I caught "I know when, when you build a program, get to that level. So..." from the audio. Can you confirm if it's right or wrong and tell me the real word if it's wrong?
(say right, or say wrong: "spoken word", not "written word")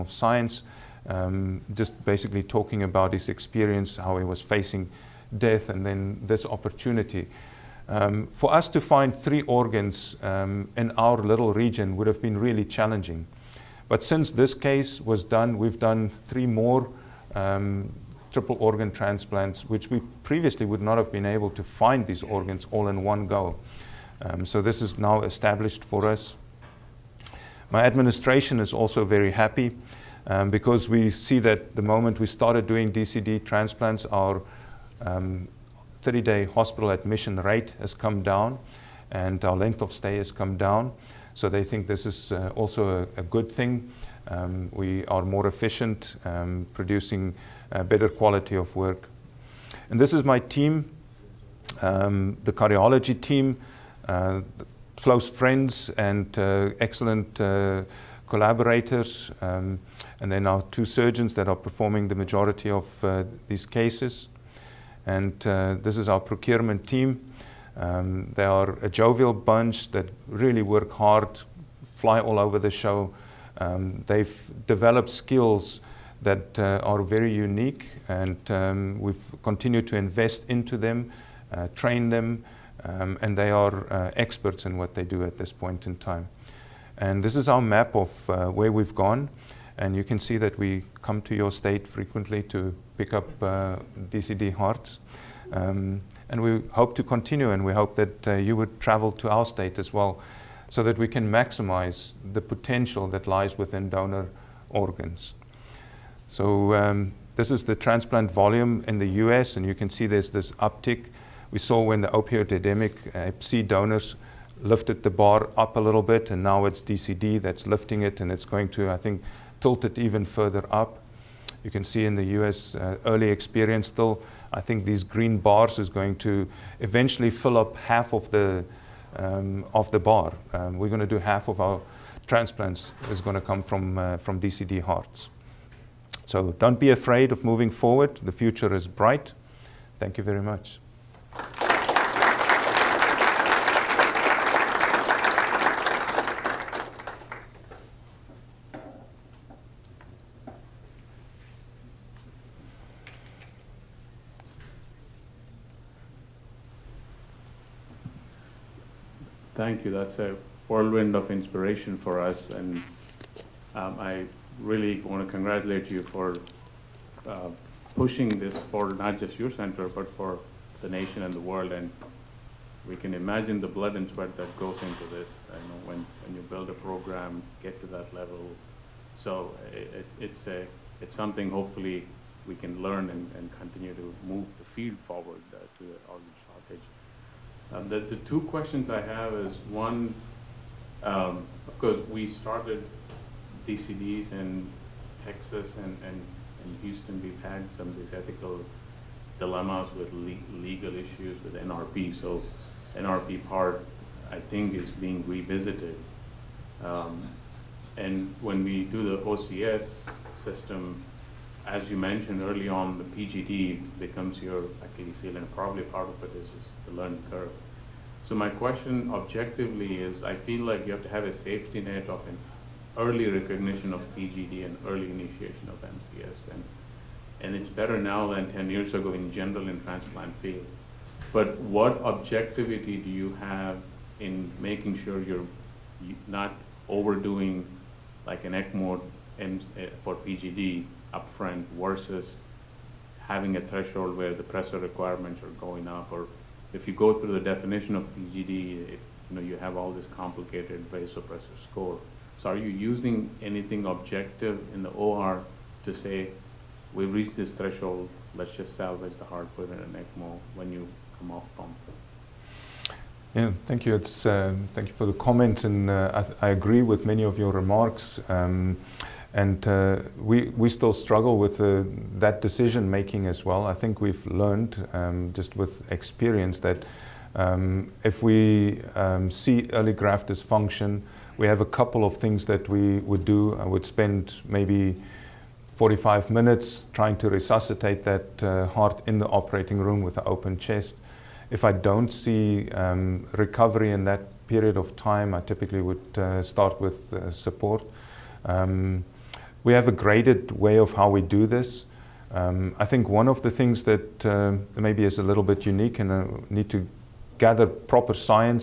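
right.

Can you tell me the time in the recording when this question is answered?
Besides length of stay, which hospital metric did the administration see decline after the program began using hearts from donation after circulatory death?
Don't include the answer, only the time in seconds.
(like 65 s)
35 s.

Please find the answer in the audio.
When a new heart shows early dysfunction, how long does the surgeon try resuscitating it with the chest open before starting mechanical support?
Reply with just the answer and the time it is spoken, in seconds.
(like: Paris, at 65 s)
45 minutes, at 285 s.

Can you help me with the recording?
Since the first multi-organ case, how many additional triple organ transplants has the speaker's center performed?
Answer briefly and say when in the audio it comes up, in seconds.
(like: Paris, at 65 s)
3, at 16 s.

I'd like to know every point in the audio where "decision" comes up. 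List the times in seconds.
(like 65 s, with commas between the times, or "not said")
272 s.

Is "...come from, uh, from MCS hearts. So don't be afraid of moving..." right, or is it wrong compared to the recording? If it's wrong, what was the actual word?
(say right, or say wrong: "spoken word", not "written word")
wrong: "DCD", not "MCS".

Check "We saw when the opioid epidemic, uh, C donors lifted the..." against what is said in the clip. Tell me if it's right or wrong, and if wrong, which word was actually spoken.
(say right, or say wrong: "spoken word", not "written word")
right.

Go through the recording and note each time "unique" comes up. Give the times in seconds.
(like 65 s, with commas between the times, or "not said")
77 s, 305 s.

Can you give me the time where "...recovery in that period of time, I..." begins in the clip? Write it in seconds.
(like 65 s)
293 s.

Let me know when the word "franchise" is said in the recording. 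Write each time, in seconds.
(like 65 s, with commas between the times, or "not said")
not said.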